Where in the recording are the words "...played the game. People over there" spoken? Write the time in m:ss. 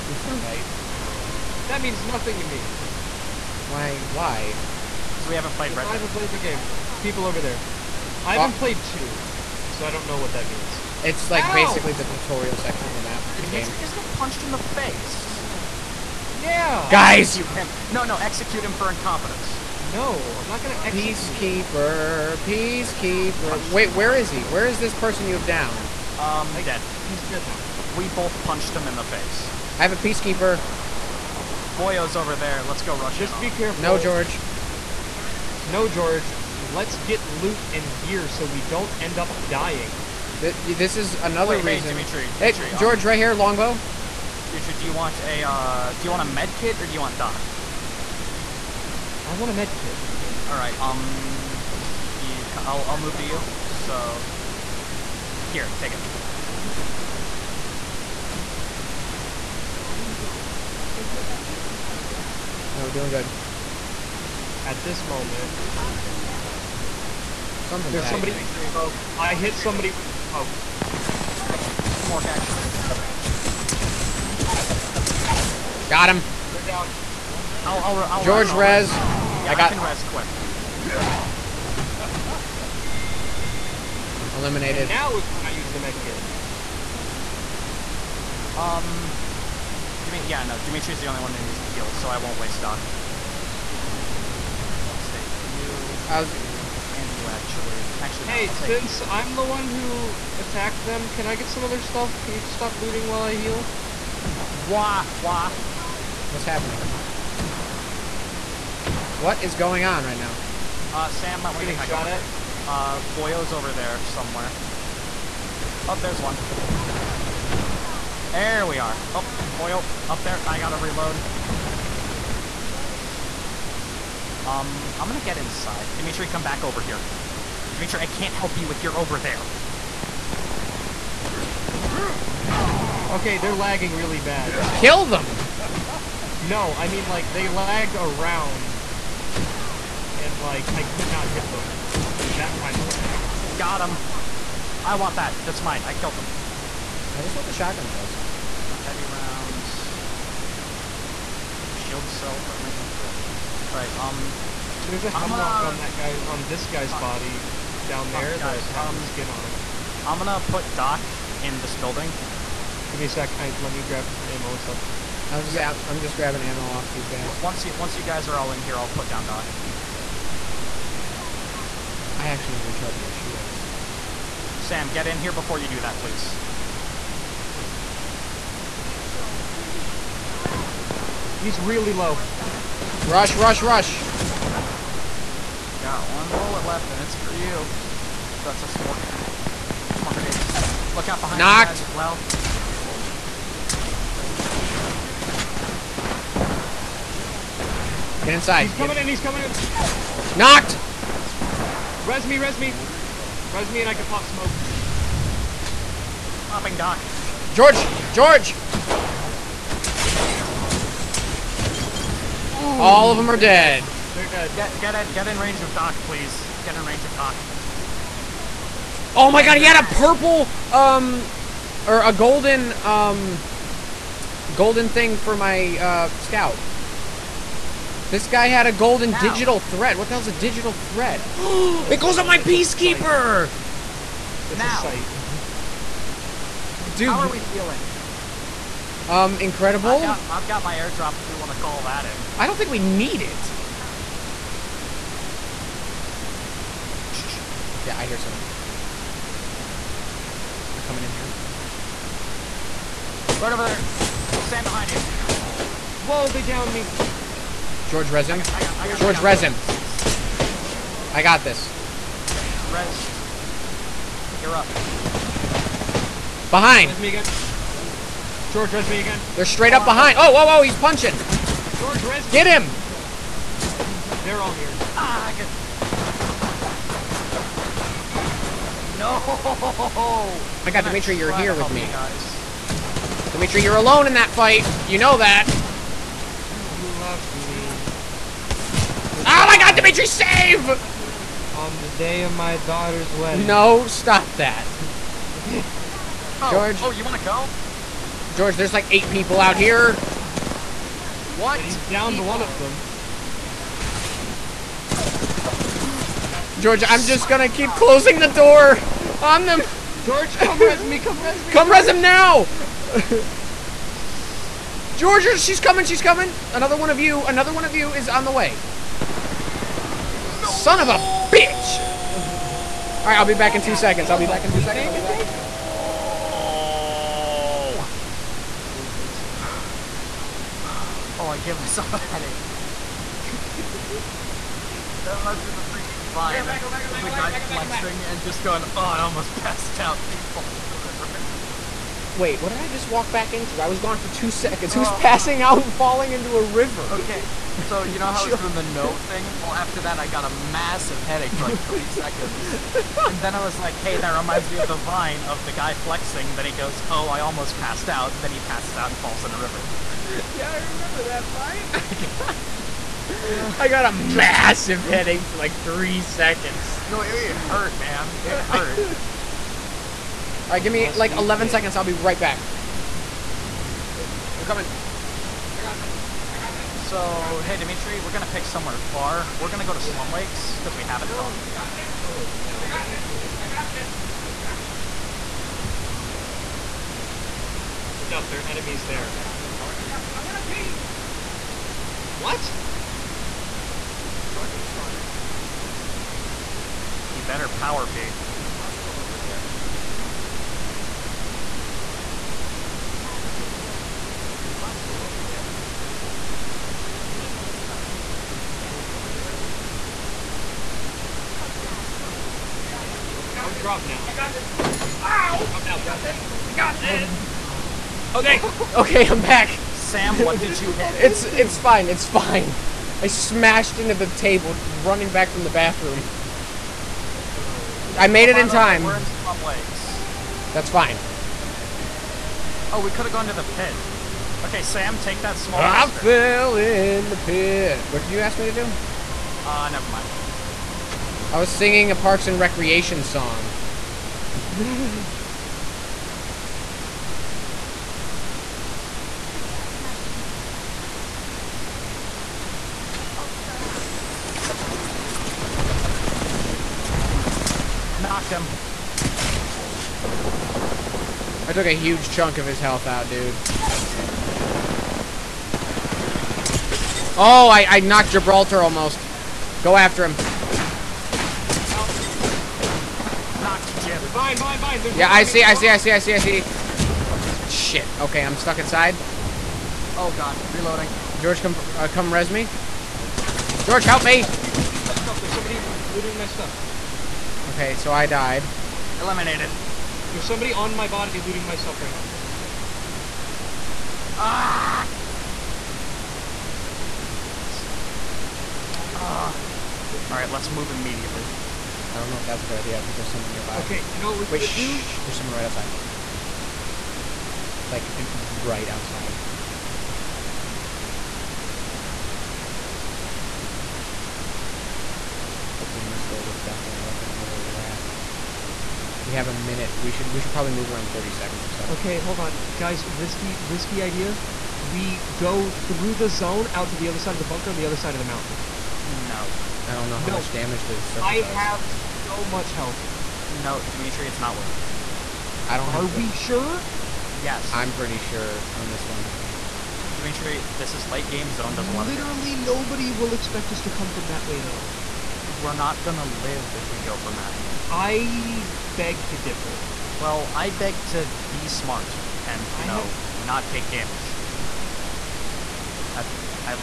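0:06.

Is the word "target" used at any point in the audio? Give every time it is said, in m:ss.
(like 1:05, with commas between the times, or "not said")
6:29, 6:34, 6:43.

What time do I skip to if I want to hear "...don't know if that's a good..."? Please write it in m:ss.
8:21.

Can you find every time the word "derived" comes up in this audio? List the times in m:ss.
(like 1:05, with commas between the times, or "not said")
not said.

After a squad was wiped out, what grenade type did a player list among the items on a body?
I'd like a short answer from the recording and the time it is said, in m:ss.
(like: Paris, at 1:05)
Frag, at 2:32.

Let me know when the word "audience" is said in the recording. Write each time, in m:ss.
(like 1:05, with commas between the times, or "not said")
not said.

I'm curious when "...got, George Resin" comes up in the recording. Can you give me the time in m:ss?
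4:18.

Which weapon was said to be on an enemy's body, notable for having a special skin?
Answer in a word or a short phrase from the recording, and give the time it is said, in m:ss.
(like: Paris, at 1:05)
Hemlok, at 2:34.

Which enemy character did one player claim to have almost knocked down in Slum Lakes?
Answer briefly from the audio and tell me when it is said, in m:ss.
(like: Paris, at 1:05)
Gibraltar, at 7:48.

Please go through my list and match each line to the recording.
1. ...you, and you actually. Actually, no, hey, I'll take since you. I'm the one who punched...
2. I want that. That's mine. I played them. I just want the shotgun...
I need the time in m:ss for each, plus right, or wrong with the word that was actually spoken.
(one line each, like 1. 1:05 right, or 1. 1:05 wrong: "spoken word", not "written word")
1. 1:36 wrong: "attacked", not "punched"
2. 2:24 wrong: "killed", not "played".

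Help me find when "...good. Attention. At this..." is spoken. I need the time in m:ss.
1:03.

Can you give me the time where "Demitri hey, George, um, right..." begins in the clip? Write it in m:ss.
0:42.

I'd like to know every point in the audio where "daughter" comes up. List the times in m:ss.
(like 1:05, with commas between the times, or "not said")
4:52.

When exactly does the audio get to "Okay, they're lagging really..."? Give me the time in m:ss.
2:13.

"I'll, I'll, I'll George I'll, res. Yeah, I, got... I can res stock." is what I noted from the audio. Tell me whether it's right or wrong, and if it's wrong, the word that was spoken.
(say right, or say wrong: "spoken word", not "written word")
wrong: "quick", not "stock".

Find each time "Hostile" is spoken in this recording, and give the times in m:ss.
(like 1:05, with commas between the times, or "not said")
6:38, 6:44, 6:51.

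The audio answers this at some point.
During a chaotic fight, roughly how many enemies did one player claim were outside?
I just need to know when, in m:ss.
4:58.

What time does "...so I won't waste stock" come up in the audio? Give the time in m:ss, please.
1:31.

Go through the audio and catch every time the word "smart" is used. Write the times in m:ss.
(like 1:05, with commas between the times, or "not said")
3:08, 9:11.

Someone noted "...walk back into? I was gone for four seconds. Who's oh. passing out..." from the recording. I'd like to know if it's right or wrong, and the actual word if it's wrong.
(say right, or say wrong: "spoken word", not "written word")
wrong: "two", not "four".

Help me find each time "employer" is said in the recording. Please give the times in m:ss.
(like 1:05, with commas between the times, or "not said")
not said.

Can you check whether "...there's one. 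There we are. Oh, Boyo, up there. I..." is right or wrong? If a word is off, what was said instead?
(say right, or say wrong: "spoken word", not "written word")
right.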